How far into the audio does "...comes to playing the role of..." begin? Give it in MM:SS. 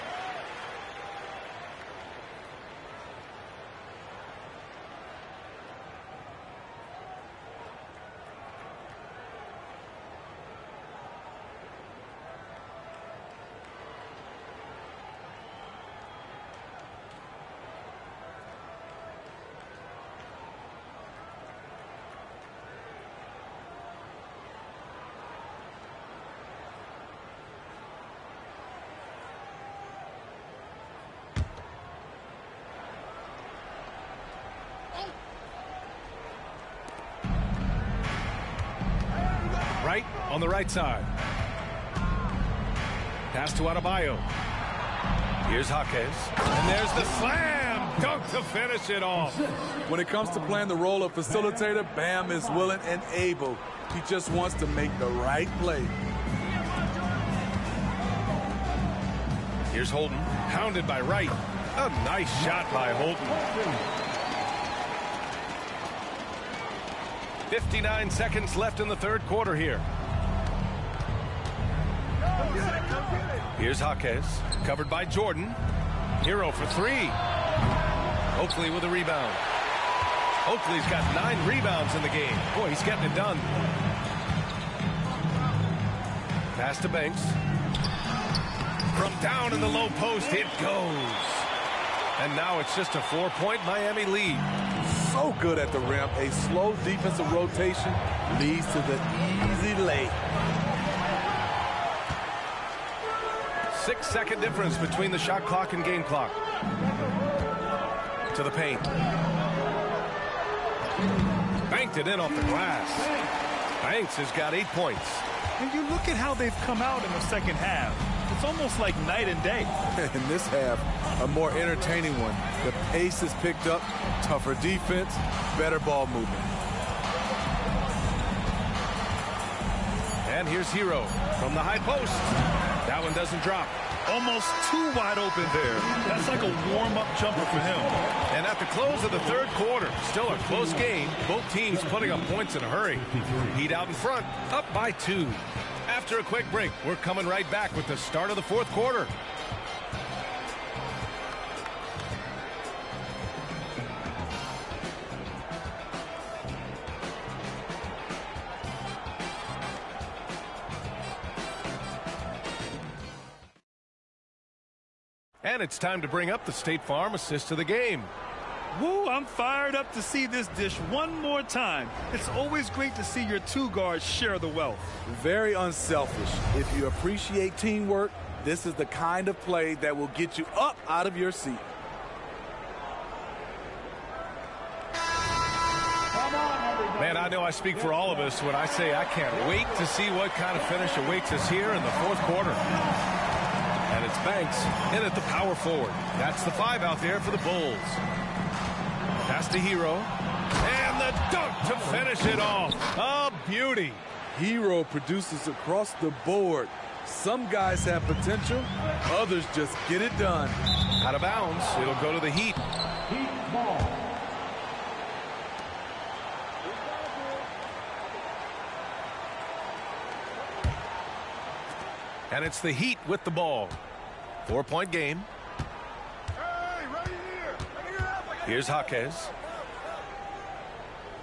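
00:50.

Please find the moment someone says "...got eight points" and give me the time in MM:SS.
01:54.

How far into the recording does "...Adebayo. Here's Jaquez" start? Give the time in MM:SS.
00:43.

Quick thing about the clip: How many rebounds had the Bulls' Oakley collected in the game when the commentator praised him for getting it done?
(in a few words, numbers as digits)
9.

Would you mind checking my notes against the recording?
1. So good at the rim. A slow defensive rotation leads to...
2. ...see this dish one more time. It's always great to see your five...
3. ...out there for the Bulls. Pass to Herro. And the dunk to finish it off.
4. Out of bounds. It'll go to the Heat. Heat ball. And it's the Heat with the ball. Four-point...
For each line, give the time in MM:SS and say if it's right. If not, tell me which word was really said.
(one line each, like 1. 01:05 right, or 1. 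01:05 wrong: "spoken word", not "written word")
1. 01:35 right
2. 02:50 wrong: "two", not "five"
3. 03:16 right
4. 03:31 right.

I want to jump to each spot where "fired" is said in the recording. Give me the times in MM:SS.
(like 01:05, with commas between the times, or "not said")
02:49.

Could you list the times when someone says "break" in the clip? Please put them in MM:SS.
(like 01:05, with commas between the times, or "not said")
02:26.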